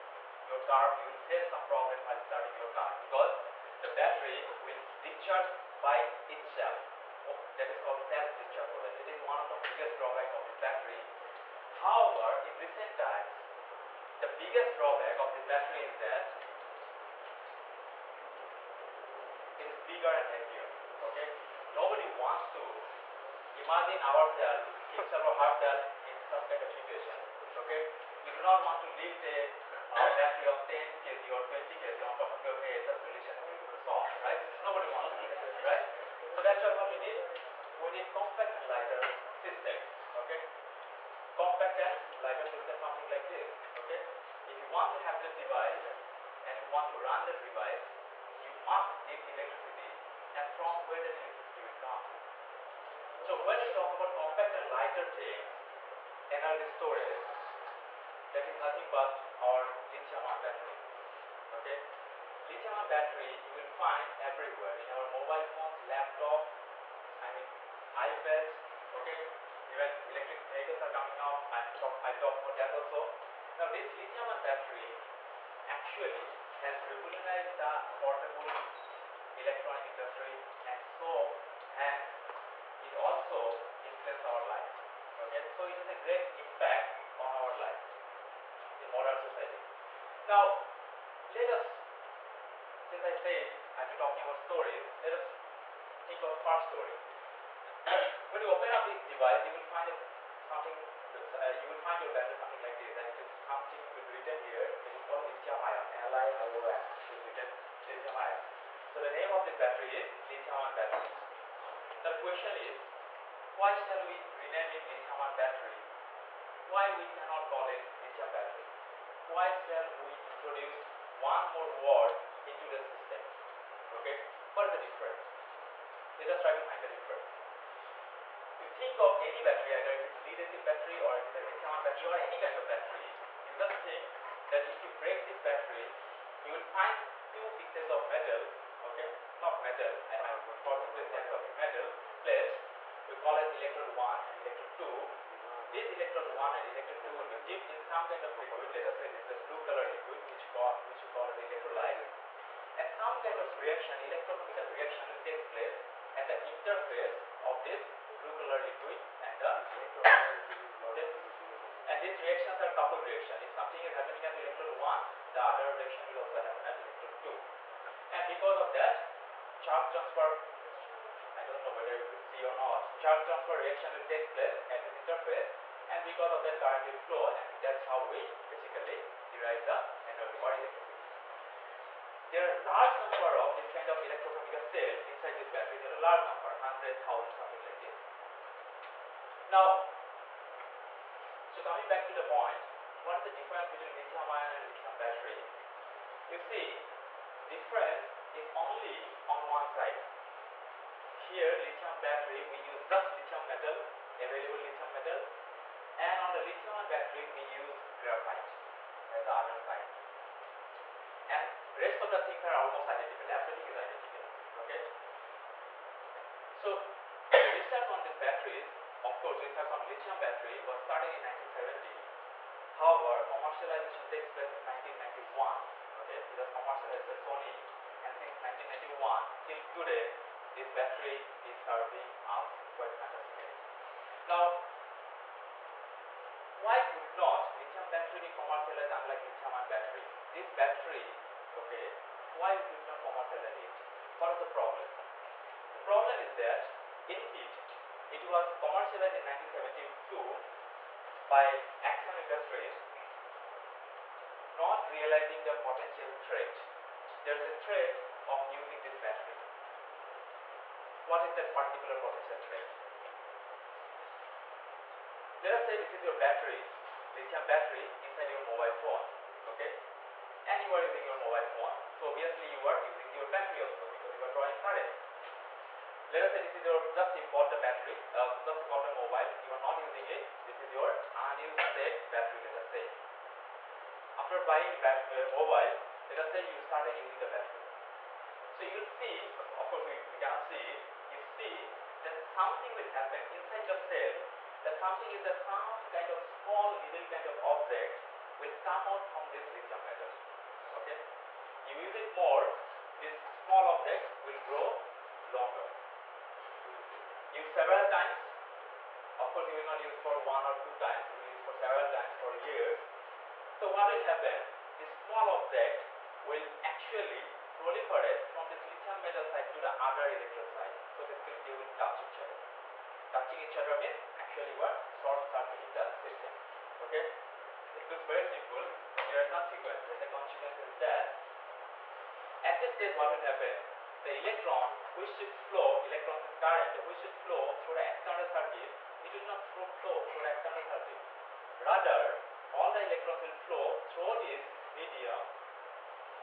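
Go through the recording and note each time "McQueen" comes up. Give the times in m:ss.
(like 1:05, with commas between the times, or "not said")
not said.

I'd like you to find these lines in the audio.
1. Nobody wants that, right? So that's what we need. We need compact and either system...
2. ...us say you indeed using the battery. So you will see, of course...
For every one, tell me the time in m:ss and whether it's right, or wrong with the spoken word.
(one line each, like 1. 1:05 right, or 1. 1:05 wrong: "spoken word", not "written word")
1. 0:34 wrong: "lighter", not "either"
2. 4:46 wrong: "started", not "indeed".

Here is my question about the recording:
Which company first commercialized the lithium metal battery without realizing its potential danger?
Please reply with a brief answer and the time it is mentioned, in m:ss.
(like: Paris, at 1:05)
Exxon Industries, at 4:11.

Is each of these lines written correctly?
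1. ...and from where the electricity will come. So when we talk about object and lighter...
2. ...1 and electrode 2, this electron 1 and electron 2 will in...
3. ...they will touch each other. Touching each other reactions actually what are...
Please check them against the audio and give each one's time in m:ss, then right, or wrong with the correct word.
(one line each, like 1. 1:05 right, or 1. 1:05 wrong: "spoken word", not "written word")
1. 0:50 wrong: "compact", not "object"
2. 2:23 right
3. 5:21 wrong: "means", not "reactions".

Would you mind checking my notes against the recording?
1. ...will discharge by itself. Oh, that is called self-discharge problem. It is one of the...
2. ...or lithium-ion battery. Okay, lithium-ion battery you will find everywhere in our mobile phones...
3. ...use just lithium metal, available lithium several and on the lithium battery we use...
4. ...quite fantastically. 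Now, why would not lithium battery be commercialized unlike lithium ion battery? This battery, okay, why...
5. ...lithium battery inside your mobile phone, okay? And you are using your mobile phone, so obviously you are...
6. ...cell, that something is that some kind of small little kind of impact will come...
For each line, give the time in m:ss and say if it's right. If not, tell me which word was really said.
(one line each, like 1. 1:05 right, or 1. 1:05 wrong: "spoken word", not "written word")
1. 0:04 right
2. 0:59 right
3. 3:22 wrong: "metal", not "several"
4. 3:52 right
5. 4:27 right
6. 4:53 wrong: "object", not "impact".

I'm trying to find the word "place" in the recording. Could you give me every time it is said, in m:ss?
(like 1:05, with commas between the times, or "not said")
2:35, 2:54, 3:44.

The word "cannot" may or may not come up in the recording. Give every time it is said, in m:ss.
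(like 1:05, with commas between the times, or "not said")
1:57, 4:50.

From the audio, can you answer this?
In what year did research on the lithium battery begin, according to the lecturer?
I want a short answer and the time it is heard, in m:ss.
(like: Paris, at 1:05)
1970, at 3:41.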